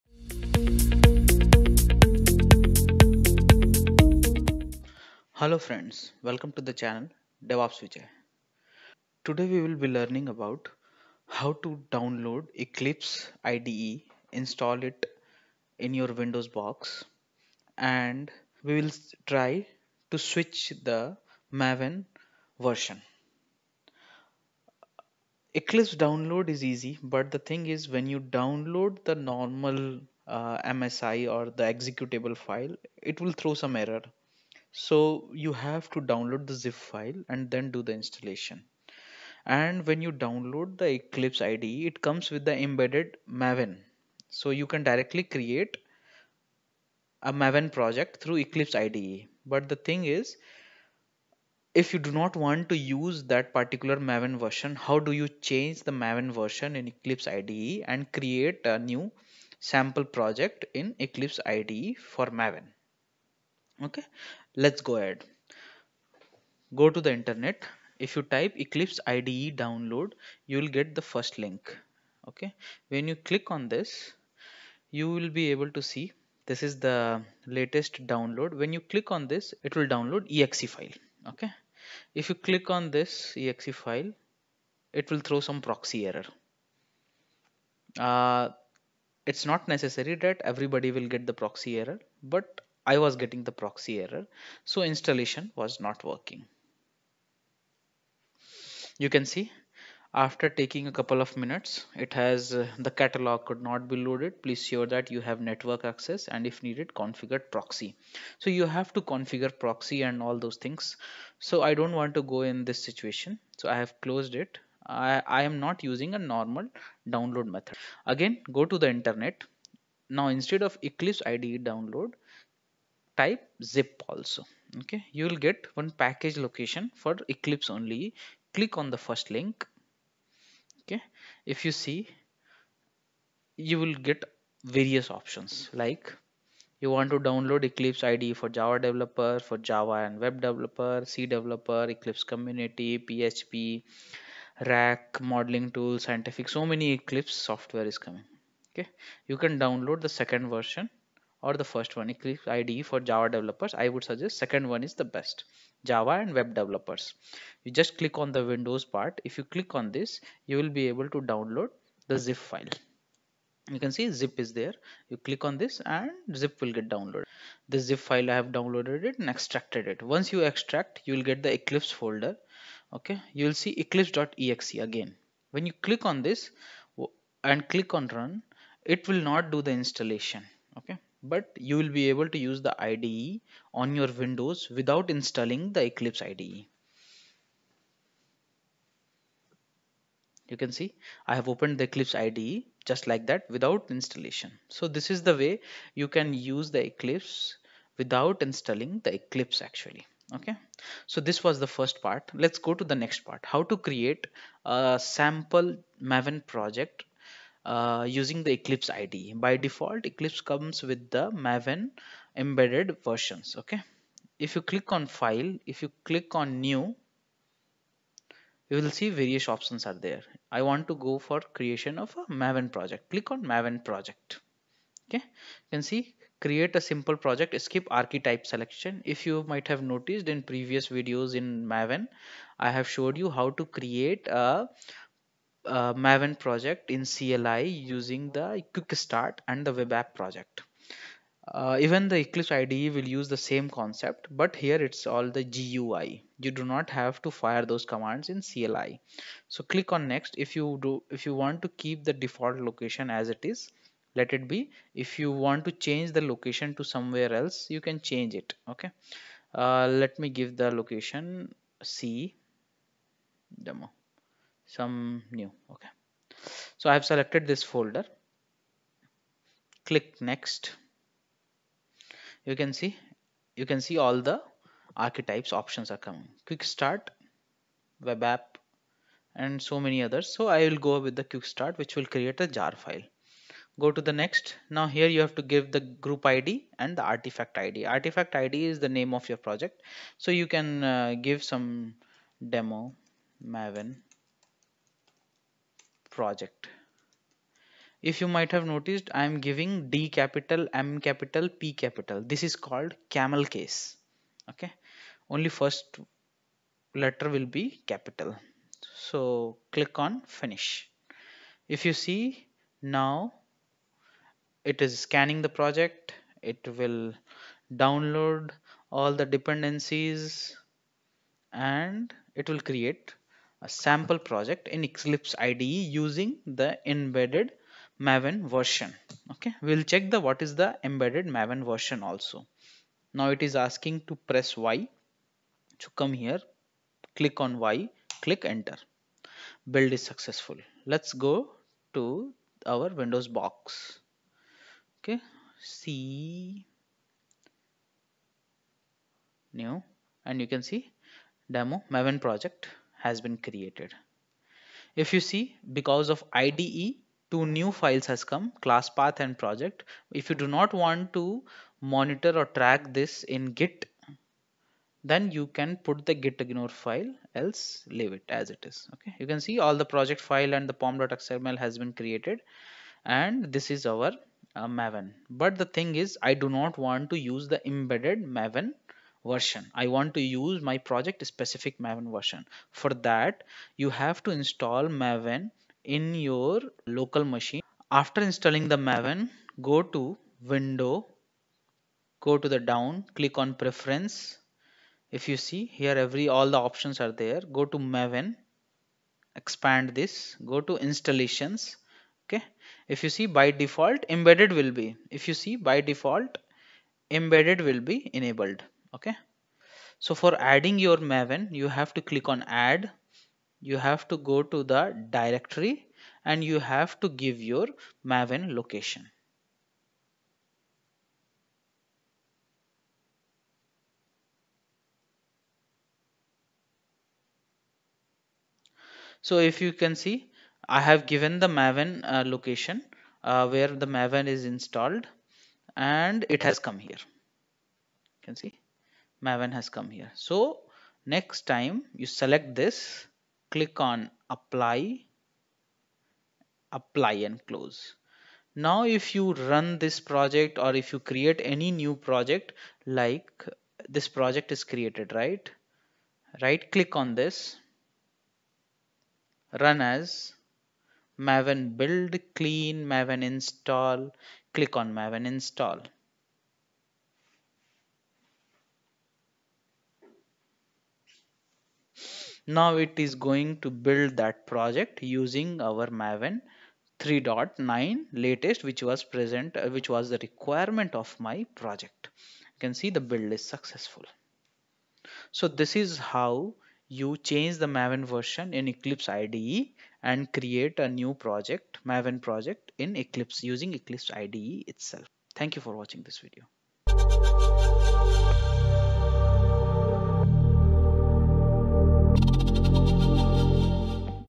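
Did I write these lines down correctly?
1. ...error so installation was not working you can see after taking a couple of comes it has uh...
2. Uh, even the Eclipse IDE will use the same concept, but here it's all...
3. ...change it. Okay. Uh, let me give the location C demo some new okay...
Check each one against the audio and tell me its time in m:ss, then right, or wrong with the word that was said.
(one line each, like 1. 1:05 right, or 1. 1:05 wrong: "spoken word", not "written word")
1. 1:34 wrong: "minutes", not "comes"
2. 4:01 right
3. 4:18 right.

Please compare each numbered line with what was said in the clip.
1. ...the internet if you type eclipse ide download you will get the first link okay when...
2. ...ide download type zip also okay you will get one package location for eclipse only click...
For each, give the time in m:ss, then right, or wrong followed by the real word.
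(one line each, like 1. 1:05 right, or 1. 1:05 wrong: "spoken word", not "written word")
1. 1:07 right
2. 2:01 right.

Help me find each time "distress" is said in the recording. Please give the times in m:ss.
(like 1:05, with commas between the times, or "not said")
not said.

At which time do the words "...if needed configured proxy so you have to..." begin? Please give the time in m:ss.
1:46.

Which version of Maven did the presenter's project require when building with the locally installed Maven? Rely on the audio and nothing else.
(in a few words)
3.9.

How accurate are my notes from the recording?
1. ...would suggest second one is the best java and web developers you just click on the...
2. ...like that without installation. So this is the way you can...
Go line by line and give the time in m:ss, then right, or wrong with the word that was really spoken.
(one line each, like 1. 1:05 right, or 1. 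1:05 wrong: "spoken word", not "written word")
1. 2:33 right
2. 3:13 right.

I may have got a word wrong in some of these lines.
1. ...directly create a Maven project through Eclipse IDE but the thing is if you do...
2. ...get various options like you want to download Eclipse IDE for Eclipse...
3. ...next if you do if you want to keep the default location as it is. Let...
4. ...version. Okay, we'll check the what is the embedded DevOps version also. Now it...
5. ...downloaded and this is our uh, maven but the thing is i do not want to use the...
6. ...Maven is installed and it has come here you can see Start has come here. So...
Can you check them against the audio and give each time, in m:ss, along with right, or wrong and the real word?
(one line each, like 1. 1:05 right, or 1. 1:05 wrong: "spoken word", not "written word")
1. 0:44 right
2. 2:14 wrong: "Java", not "Eclipse"
3. 4:10 right
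4. 5:28 wrong: "Maven", not "DevOps"
5. 6:12 wrong: "created", not "downloaded"
6. 7:13 wrong: "Maven", not "Start".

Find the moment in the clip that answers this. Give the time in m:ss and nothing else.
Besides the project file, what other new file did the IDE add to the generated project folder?
5:58.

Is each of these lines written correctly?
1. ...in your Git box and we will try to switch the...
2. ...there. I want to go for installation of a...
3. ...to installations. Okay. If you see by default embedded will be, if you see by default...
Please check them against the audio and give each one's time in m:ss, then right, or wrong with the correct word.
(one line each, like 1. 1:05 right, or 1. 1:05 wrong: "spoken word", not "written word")
1. 0:15 wrong: "Windows", not "Git"
2. 3:39 wrong: "creation", not "installation"
3. 6:40 right.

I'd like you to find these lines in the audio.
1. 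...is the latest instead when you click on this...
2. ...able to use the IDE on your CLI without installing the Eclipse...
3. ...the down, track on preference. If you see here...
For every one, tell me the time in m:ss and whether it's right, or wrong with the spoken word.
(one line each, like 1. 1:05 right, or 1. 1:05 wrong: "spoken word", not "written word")
1. 1:16 wrong: "download", not "instead"
2. 3:02 wrong: "Windows", not "CLI"
3. 6:32 wrong: "click", not "track".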